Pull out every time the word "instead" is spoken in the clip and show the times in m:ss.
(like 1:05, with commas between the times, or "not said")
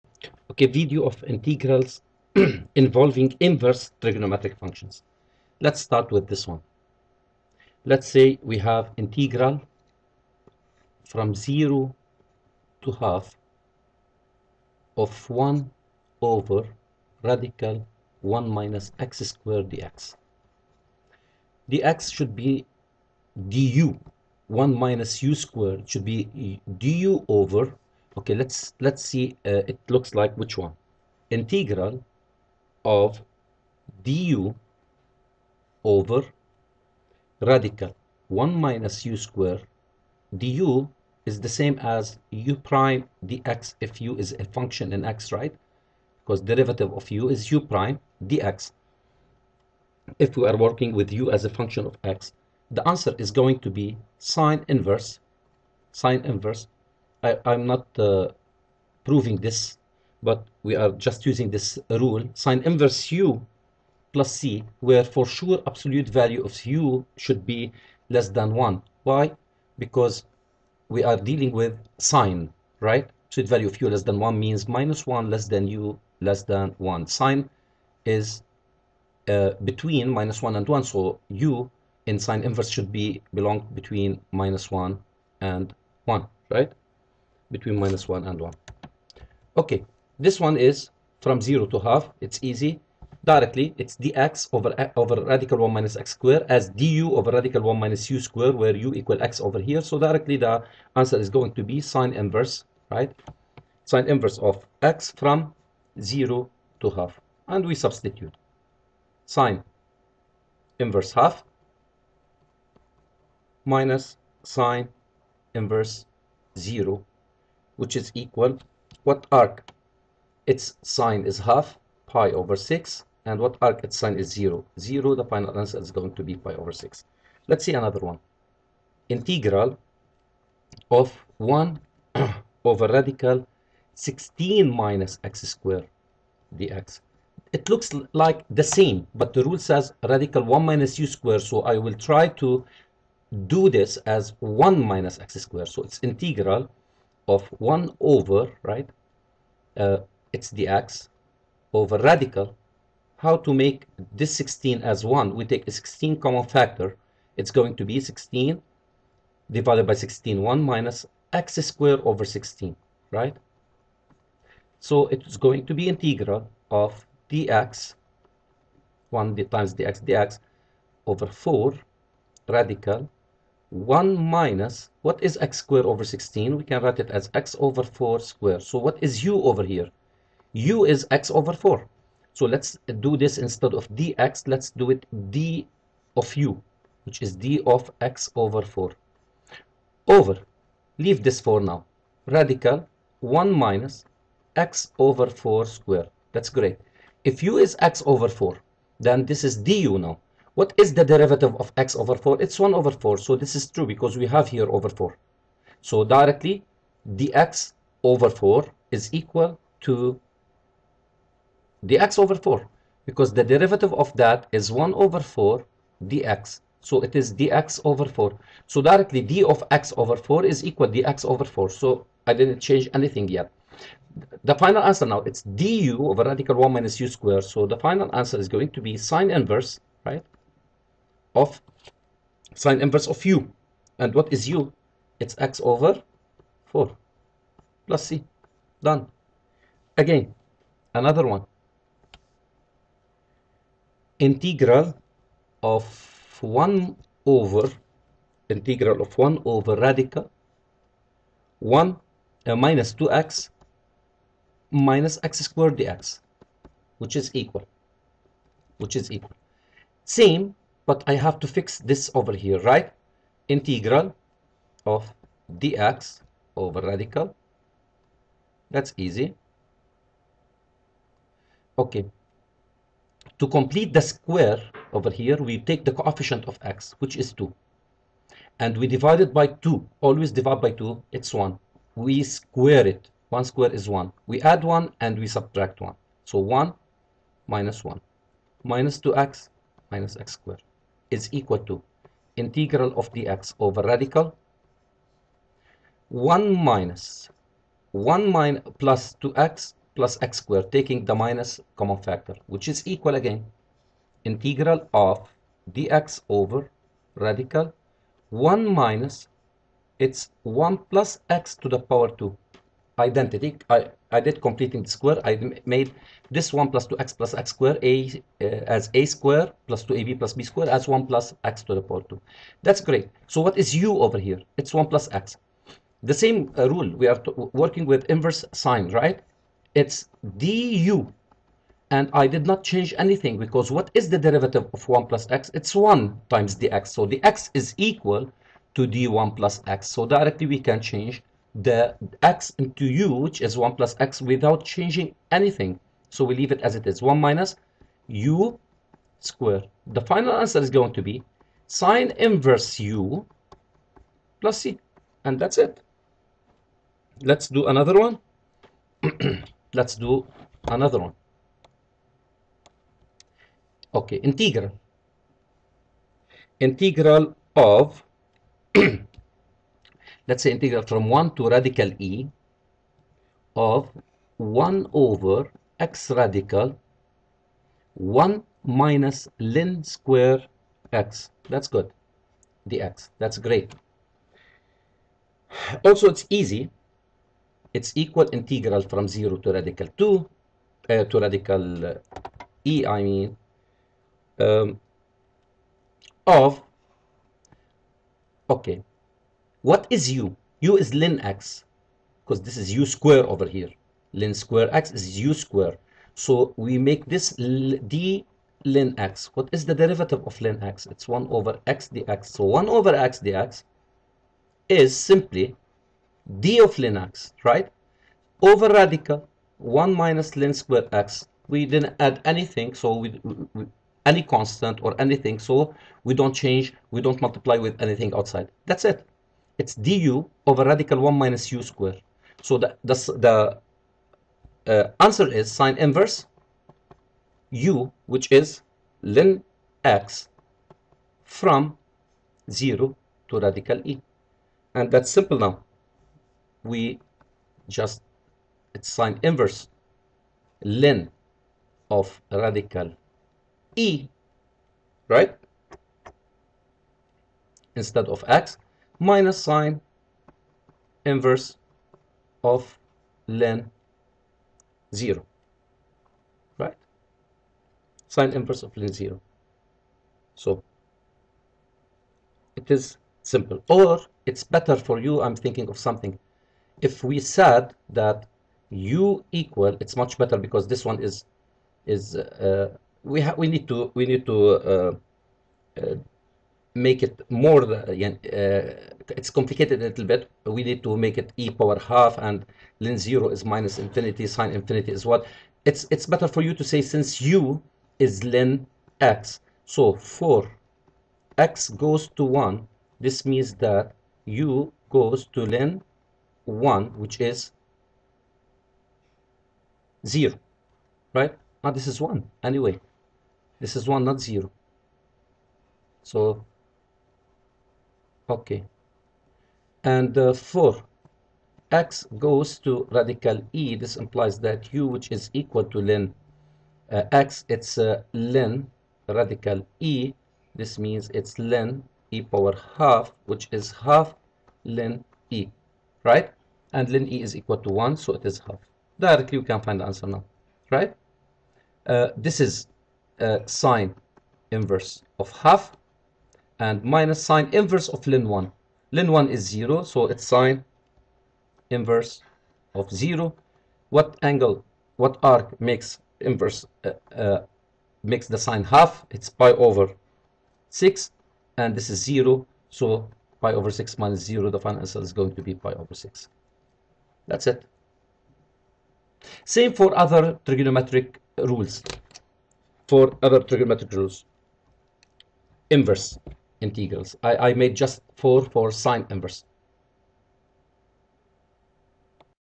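3:03, 7:37.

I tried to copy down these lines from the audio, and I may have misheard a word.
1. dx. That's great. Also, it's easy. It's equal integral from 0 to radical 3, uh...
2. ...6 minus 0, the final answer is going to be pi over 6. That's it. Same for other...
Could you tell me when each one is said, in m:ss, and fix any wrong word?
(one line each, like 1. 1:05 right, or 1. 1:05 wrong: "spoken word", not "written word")
1. 6:22 wrong: "2", not "3"
2. 9:23 right.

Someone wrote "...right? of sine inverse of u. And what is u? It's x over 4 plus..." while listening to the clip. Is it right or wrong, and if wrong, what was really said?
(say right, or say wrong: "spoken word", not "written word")
right.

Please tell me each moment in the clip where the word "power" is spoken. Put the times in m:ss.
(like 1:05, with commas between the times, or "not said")
5:11, 5:21, 8:11, 8:52.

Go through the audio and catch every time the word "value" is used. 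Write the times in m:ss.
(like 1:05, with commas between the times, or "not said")
1:06, 1:13.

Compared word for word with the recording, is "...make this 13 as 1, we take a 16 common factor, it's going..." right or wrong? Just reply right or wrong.
wrong.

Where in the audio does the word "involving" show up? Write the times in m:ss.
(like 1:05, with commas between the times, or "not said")
0:02.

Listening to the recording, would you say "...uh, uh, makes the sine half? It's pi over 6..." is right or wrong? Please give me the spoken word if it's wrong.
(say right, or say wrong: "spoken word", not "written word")
right.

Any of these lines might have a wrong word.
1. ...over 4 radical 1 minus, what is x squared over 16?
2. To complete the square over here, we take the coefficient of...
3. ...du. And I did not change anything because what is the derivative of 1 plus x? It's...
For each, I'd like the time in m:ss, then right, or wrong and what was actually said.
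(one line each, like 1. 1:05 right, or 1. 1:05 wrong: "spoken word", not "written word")
1. 2:51 right
2. 4:33 right
3. 5:30 right.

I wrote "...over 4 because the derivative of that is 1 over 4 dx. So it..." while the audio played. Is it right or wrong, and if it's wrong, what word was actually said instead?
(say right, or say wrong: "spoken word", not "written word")
right.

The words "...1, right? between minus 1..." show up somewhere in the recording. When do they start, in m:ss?
1:26.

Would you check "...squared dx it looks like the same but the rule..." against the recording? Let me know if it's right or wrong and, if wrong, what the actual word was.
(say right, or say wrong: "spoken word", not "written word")
right.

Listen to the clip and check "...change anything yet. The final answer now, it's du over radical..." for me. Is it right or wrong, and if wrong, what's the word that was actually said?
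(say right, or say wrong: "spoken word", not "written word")
right.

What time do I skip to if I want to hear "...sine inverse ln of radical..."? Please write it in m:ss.
7:28.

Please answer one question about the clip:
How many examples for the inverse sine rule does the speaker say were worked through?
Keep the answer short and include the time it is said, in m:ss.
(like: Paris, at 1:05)
4, at 9:38.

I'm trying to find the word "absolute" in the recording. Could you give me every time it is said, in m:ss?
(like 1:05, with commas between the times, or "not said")
1:05, 1:13.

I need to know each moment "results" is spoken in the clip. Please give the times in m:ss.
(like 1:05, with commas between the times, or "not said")
not said.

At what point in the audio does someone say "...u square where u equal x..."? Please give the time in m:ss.
1:38.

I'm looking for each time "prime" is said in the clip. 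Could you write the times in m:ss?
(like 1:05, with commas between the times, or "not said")
0:42, 0:47.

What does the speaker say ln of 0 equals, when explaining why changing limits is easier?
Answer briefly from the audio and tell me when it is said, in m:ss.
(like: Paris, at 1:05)
minus infinity, at 8:13.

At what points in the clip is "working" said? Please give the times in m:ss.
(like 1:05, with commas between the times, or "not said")
0:50, 5:27.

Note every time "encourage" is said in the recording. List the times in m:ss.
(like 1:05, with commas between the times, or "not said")
not said.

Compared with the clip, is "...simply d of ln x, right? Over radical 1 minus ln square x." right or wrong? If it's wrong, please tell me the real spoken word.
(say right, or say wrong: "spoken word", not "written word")
right.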